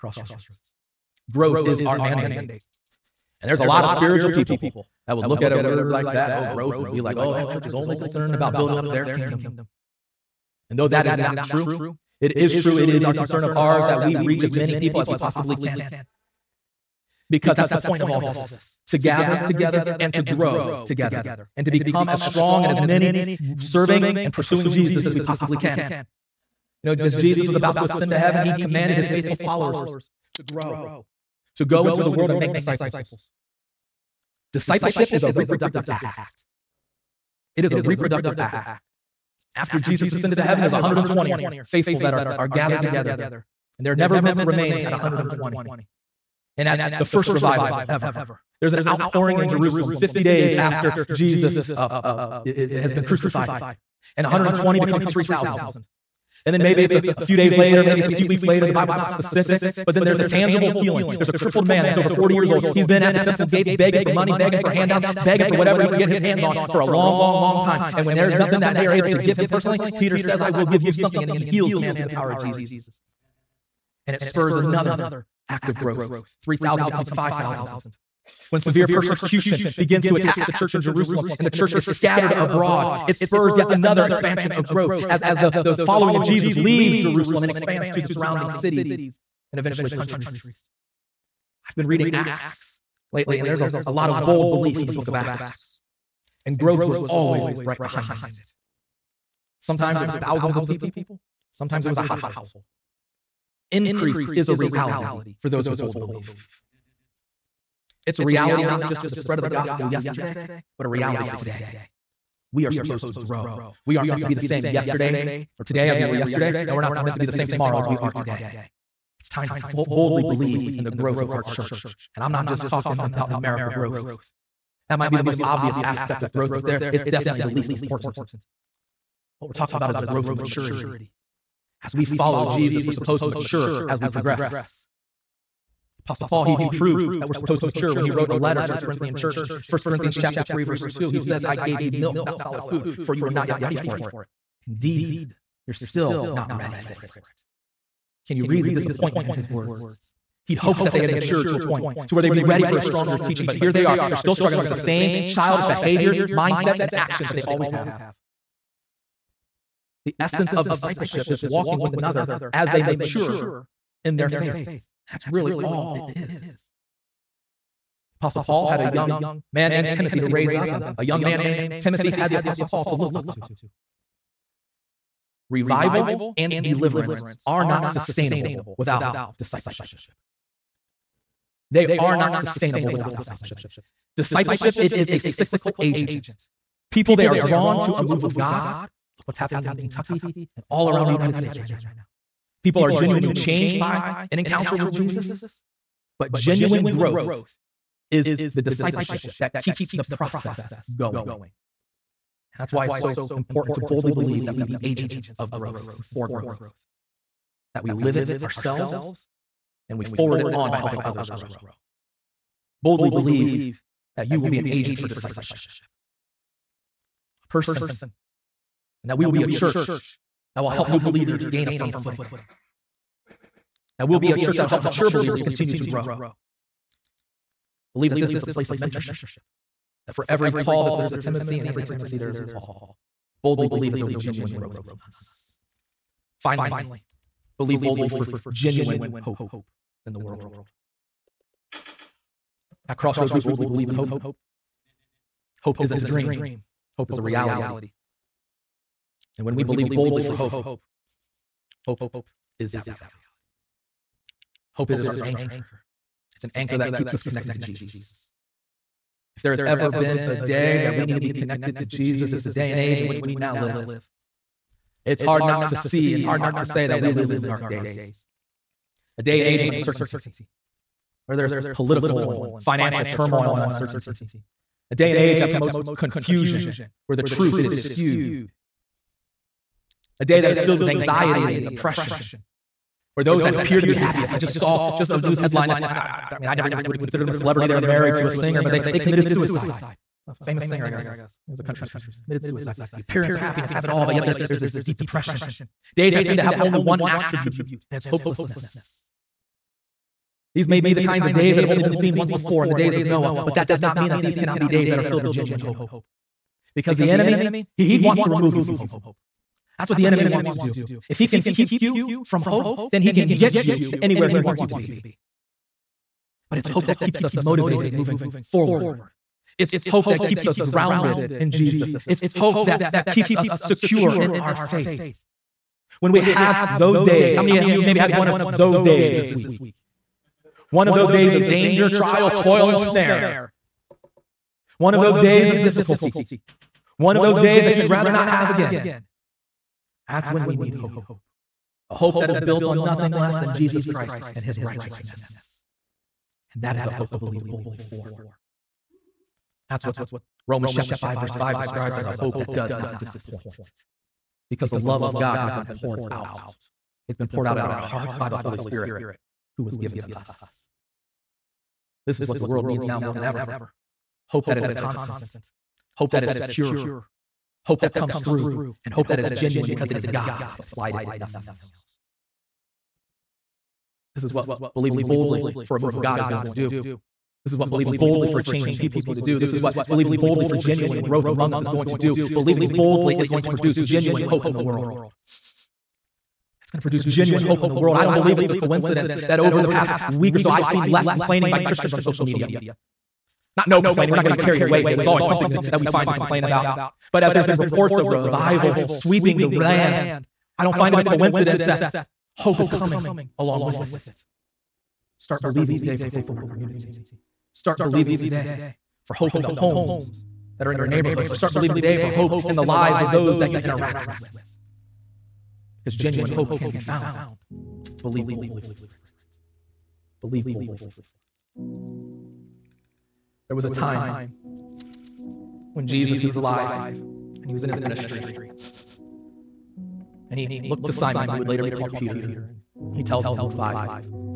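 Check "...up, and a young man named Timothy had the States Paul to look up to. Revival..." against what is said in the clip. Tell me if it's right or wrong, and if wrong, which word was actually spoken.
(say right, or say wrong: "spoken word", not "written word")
wrong: "Apostle", not "States".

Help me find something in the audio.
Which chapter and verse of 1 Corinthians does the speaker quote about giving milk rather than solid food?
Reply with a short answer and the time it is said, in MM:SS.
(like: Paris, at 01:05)
Chapter 3 verse 2, at 02:20.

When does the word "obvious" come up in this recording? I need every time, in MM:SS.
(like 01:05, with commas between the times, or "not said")
02:05.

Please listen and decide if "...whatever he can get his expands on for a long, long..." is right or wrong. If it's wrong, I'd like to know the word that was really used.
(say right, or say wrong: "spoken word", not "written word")
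wrong: "hands", not "expands".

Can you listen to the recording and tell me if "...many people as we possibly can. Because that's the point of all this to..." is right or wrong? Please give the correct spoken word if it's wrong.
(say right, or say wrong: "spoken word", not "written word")
right.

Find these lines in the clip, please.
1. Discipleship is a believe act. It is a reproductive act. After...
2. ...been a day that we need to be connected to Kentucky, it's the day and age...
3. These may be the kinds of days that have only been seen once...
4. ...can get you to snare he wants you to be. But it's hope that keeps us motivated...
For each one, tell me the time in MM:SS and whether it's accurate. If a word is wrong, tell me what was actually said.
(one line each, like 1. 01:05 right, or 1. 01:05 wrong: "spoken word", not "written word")
1. 00:34 wrong: "reproductive", not "believe"
2. 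04:19 wrong: "Jesus", not "Kentucky"
3. 05:00 right
4. 05:13 wrong: "anywhere", not "snare".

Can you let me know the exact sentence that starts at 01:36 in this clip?
And growth was always right behind it.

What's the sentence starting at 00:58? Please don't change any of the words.
The Bible's not specific, but then there's a tangible healing.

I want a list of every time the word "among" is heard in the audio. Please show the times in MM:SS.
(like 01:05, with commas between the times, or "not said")
03:54, 06:21.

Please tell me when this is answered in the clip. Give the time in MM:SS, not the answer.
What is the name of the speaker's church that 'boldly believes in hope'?
04:02.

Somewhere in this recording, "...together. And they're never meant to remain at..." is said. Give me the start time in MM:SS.
00:42.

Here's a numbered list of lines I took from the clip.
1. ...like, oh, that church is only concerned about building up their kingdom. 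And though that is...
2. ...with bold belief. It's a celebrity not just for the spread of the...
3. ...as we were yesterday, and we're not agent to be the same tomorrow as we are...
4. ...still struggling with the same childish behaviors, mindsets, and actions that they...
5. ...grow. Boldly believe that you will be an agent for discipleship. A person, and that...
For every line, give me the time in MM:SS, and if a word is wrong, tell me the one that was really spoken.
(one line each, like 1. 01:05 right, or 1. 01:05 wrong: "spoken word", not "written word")
1. 00:06 right
2. 01:45 wrong: "reality", not "celebrity"
3. 01:55 wrong: "meant", not "agent"
4. 02:34 right
5. 03:31 right.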